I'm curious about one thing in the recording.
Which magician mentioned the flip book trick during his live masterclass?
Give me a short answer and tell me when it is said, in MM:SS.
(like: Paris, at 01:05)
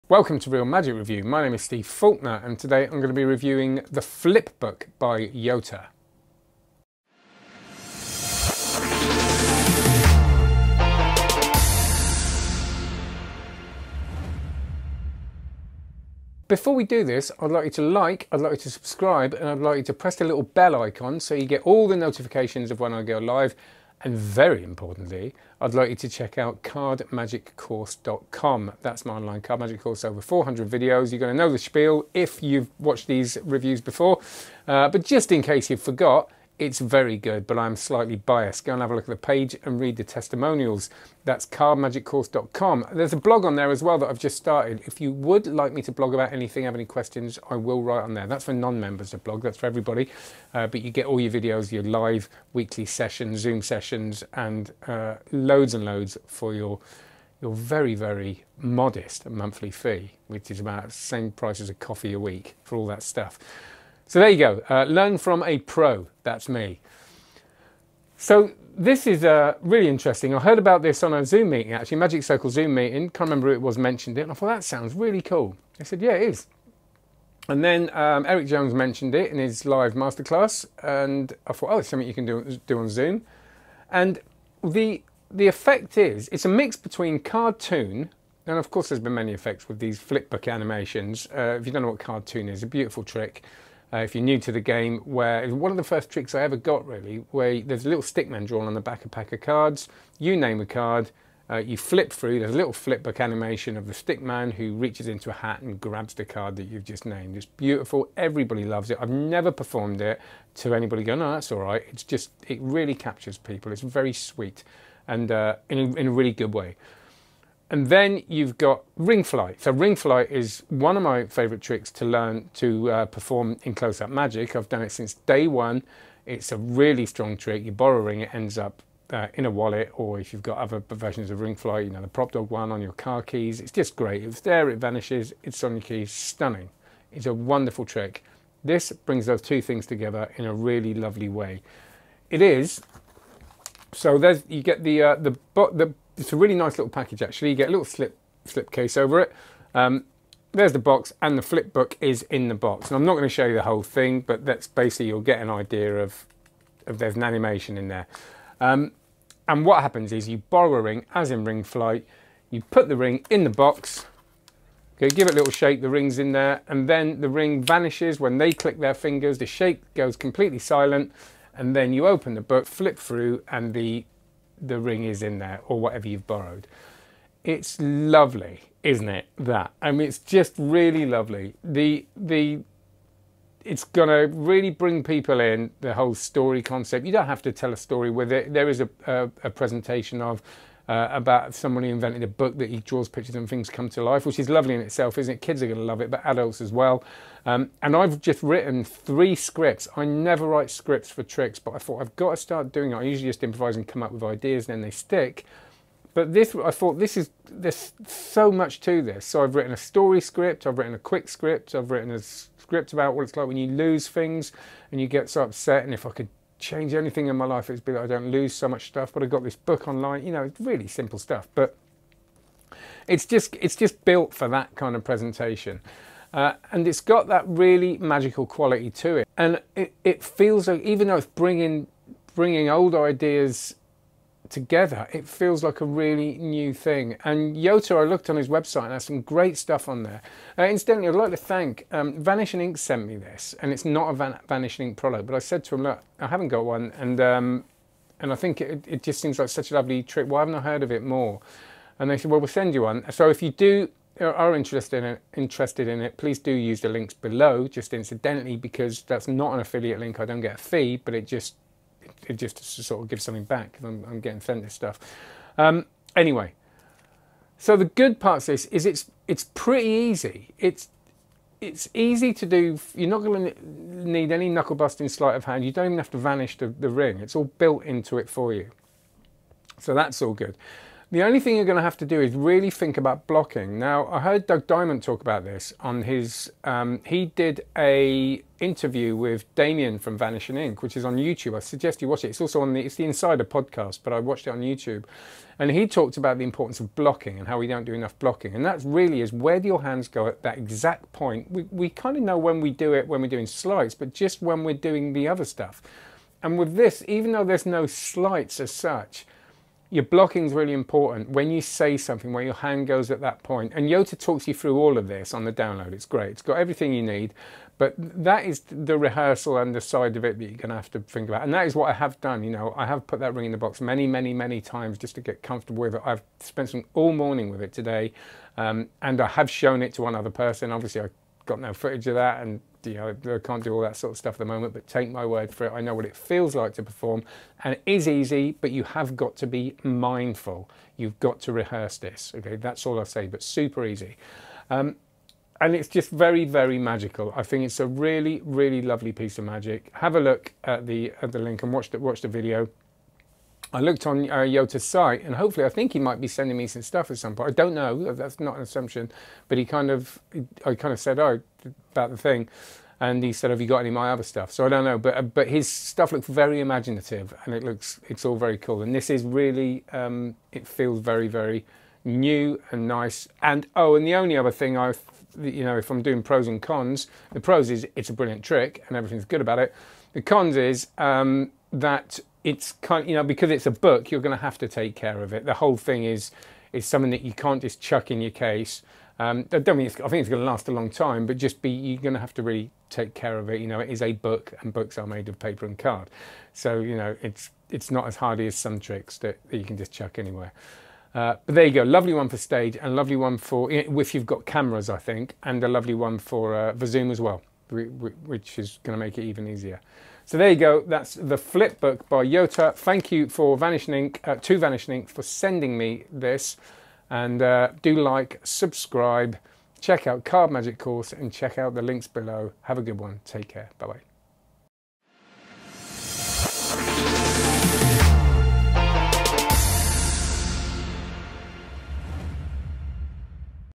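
Eric Jones, at 01:18.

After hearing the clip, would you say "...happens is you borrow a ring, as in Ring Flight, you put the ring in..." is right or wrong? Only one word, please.
right.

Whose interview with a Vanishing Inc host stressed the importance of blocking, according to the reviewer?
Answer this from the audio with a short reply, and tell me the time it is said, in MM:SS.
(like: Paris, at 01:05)
Doug Diamond, at 04:44.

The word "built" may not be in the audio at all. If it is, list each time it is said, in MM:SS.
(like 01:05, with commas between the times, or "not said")
03:44, 04:37.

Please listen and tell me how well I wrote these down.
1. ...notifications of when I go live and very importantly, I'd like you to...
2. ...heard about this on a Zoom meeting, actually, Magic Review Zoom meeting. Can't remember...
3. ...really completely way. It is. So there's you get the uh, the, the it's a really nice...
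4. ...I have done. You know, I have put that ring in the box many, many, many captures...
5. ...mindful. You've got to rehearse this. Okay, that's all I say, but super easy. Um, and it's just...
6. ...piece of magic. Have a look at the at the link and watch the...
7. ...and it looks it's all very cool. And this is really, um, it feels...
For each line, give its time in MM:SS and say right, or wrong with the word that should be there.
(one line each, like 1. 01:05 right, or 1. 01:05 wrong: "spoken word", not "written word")
1. 00:21 right
2. 01:10 wrong: "Circle", not "Review"
3. 02:20 wrong: "lovely", not "completely"
4. 05:21 wrong: "times", not "captures"
5. 05:39 right
6. 05:49 right
7. 06:07 right.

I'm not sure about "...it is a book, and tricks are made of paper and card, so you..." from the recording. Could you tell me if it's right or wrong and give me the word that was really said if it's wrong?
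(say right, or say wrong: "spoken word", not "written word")
wrong: "books", not "tricks".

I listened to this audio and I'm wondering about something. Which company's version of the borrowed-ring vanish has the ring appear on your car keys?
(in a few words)
Propdog.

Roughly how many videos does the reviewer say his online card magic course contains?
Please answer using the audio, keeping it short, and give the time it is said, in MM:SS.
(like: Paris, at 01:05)
400, at 00:30.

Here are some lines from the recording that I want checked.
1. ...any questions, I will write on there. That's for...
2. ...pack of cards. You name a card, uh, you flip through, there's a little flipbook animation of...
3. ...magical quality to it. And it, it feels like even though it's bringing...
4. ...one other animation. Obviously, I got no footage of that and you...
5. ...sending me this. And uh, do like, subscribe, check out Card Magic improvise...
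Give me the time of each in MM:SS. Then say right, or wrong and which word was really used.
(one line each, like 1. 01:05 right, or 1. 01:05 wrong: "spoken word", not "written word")
1. 00:46 right
2. 01:39 right
3. 03:47 right
4. 05:30 wrong: "person", not "animation"
5. 06:55 wrong: "course", not "improvise".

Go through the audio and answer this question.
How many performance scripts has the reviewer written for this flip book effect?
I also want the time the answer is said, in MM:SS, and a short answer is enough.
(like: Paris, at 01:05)
3, at 03:18.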